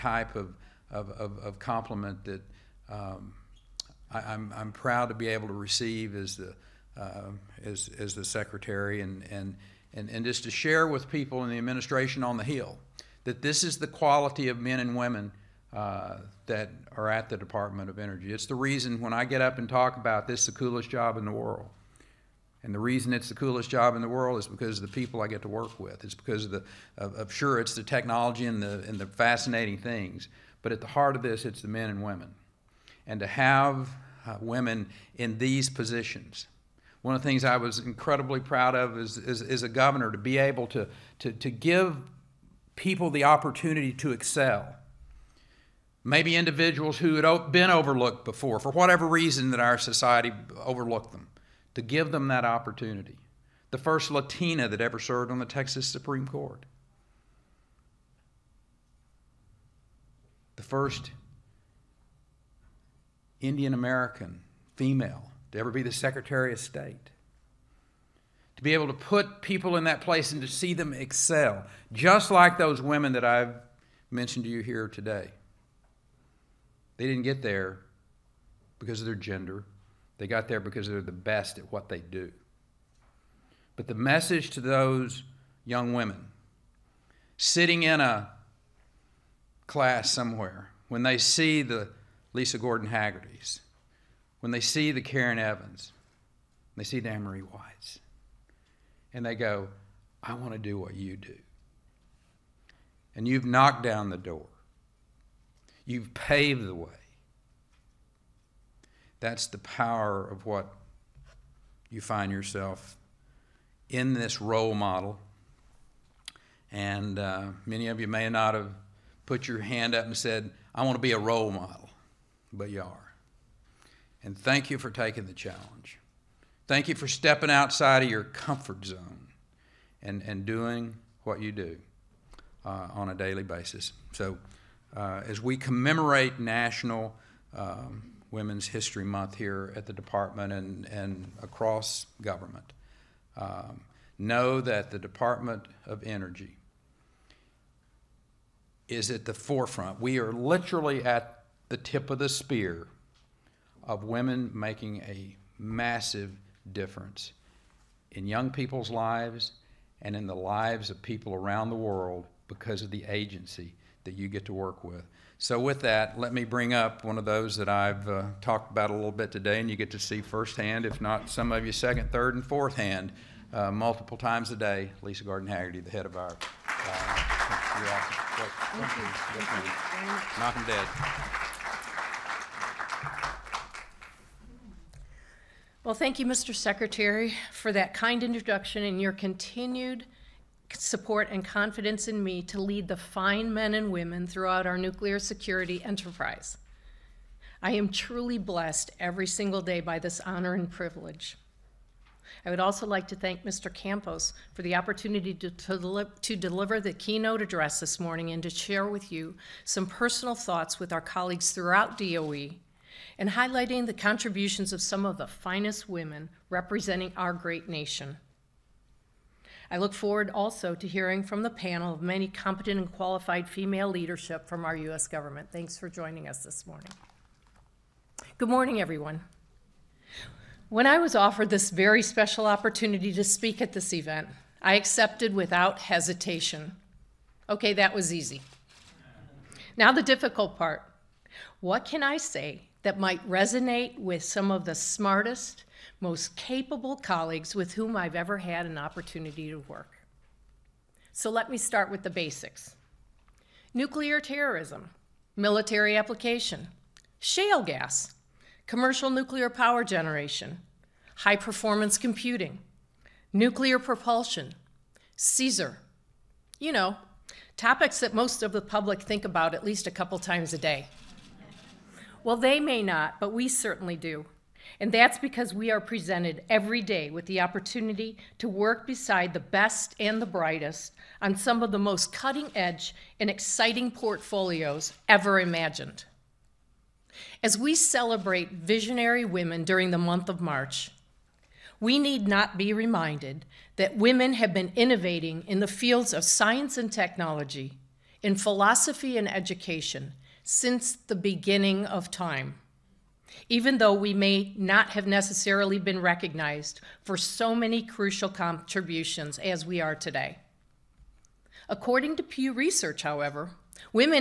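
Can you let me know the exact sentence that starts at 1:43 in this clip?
And you've knocked down the door.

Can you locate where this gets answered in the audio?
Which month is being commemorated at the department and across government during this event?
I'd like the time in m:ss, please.
2:18.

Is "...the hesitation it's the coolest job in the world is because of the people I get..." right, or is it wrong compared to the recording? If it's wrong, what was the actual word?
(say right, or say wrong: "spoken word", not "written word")
wrong: "reason", not "hesitation".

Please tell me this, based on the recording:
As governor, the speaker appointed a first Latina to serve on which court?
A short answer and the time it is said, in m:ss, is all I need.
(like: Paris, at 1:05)
Texas Supreme Court, at 0:55.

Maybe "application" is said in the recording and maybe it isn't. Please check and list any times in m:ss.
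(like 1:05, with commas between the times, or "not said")
4:15.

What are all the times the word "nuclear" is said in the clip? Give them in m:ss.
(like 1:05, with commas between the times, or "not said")
3:14, 4:13, 4:19, 4:23.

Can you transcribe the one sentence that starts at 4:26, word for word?
You know, topics that most of the public think about at least a couple times a day.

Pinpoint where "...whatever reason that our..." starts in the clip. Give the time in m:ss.
0:48.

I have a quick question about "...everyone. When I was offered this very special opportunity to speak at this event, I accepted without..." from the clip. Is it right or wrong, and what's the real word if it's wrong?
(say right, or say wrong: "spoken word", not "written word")
right.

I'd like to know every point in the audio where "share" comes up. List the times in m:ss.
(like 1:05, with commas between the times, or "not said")
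0:10, 3:28.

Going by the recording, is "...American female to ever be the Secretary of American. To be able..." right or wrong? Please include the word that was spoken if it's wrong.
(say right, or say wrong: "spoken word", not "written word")
wrong: "State", not "American".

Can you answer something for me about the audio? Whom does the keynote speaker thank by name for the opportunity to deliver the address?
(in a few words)
Mr. Campos.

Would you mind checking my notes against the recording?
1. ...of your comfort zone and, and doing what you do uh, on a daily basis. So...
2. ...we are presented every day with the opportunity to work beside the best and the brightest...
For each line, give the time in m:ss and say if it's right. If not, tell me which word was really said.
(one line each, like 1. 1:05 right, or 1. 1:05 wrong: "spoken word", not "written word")
1. 2:08 right
2. 4:35 right.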